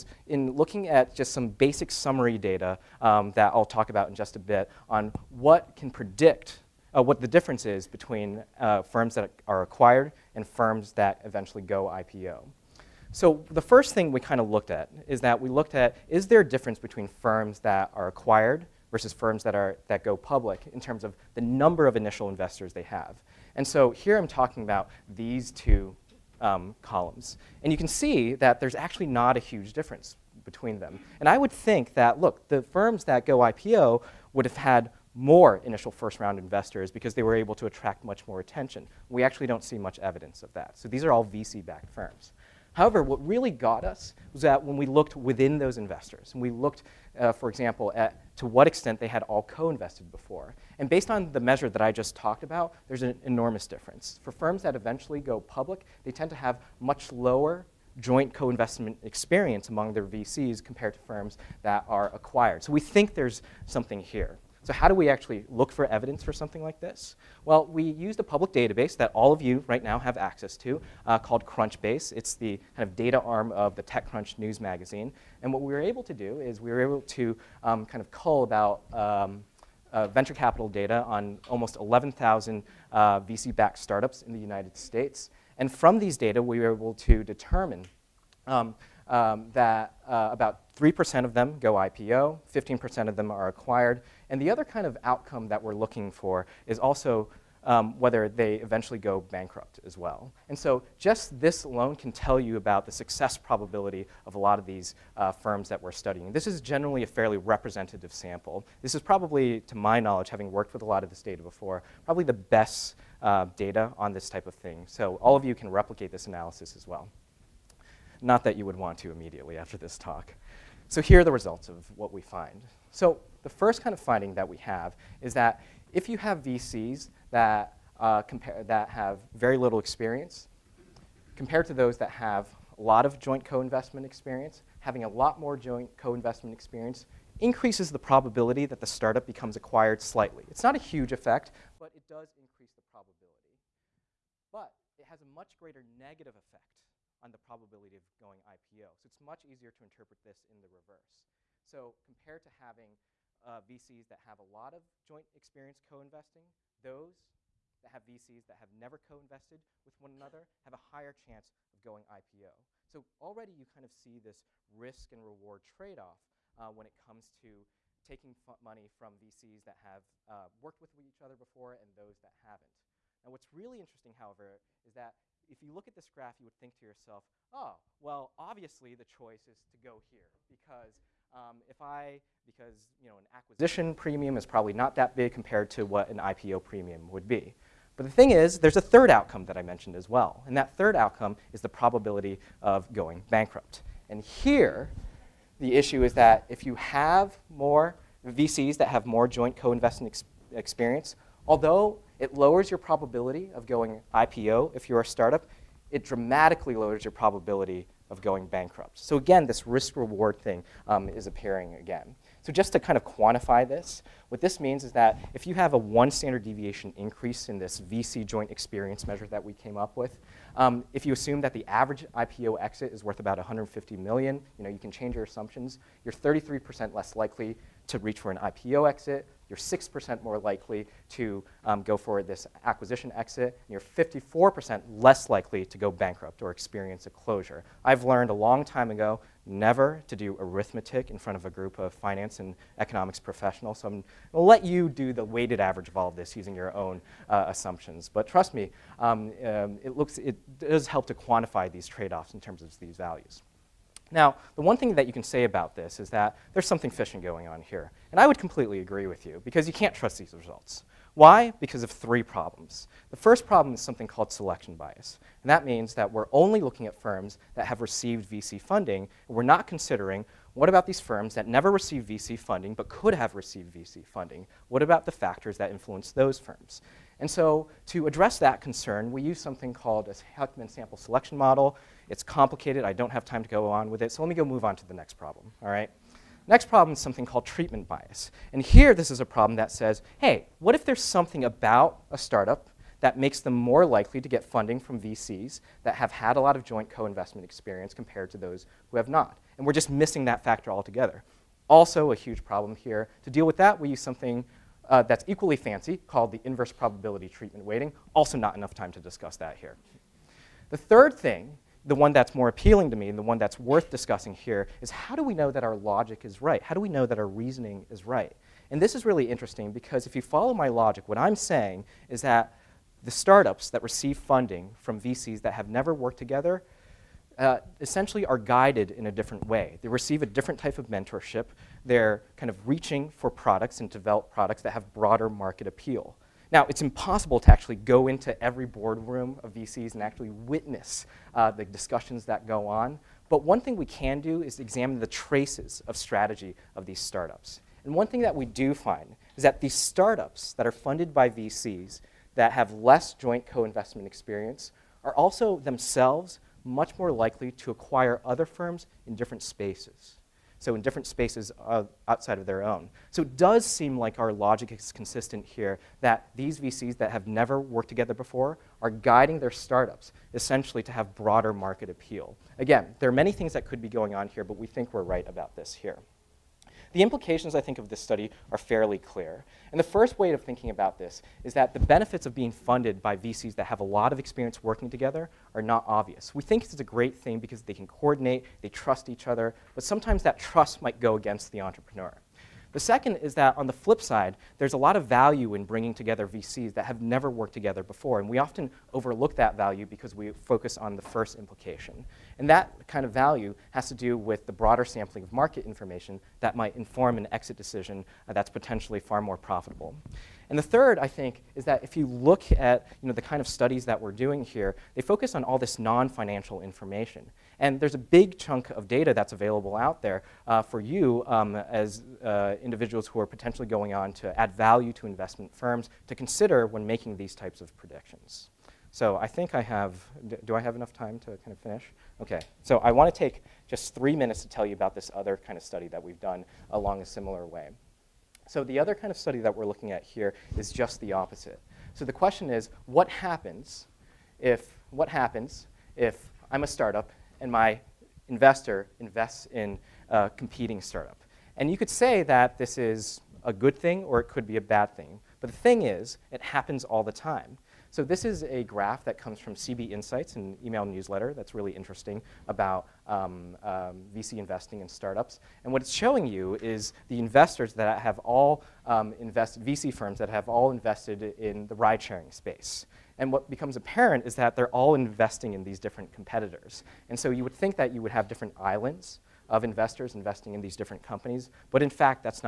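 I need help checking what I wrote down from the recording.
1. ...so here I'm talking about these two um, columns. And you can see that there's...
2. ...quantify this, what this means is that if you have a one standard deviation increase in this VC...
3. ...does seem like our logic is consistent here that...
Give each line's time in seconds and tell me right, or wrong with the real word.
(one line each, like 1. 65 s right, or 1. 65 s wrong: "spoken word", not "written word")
1. 23 s right
2. 213 s right
3. 363 s right.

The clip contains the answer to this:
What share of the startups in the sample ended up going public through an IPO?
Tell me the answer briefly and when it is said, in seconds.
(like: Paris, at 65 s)
3%, at 90 s.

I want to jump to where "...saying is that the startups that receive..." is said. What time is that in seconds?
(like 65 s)
321 s.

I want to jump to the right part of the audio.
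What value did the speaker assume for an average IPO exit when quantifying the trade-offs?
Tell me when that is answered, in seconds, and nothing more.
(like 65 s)
223 s.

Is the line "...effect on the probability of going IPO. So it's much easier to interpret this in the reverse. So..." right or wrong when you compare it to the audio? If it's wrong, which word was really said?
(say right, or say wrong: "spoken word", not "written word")
right.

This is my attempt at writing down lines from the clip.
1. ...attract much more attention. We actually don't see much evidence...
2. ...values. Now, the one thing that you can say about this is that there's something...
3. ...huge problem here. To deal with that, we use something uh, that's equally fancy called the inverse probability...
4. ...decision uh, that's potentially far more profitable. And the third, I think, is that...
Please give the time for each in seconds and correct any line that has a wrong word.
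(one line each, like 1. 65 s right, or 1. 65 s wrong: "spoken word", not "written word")
1. 37 s right
2. 252 s right
3. 302 s right
4. 407 s right.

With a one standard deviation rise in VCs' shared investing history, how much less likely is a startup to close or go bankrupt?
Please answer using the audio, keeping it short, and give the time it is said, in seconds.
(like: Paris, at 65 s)
54%, at 233 s.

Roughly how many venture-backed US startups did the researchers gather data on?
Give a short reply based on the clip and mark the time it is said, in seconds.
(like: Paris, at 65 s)
11,000, at 81 s.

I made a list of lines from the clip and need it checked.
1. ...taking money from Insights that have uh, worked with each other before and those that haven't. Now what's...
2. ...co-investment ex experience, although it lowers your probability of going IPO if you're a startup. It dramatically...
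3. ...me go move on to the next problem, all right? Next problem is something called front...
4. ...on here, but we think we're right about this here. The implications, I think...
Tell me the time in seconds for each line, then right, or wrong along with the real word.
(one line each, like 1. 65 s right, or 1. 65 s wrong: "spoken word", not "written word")
1. 168 s wrong: "VCs", not "Insights"
2. 199 s right
3. 284 s wrong: "treatment", not "front"
4. 374 s right.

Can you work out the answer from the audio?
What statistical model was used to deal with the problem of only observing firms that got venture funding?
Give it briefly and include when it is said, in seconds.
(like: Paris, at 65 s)
Heckman sample selection model, at 280 s.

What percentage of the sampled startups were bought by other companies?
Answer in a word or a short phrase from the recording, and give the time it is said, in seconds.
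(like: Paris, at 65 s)
15%, at 92 s.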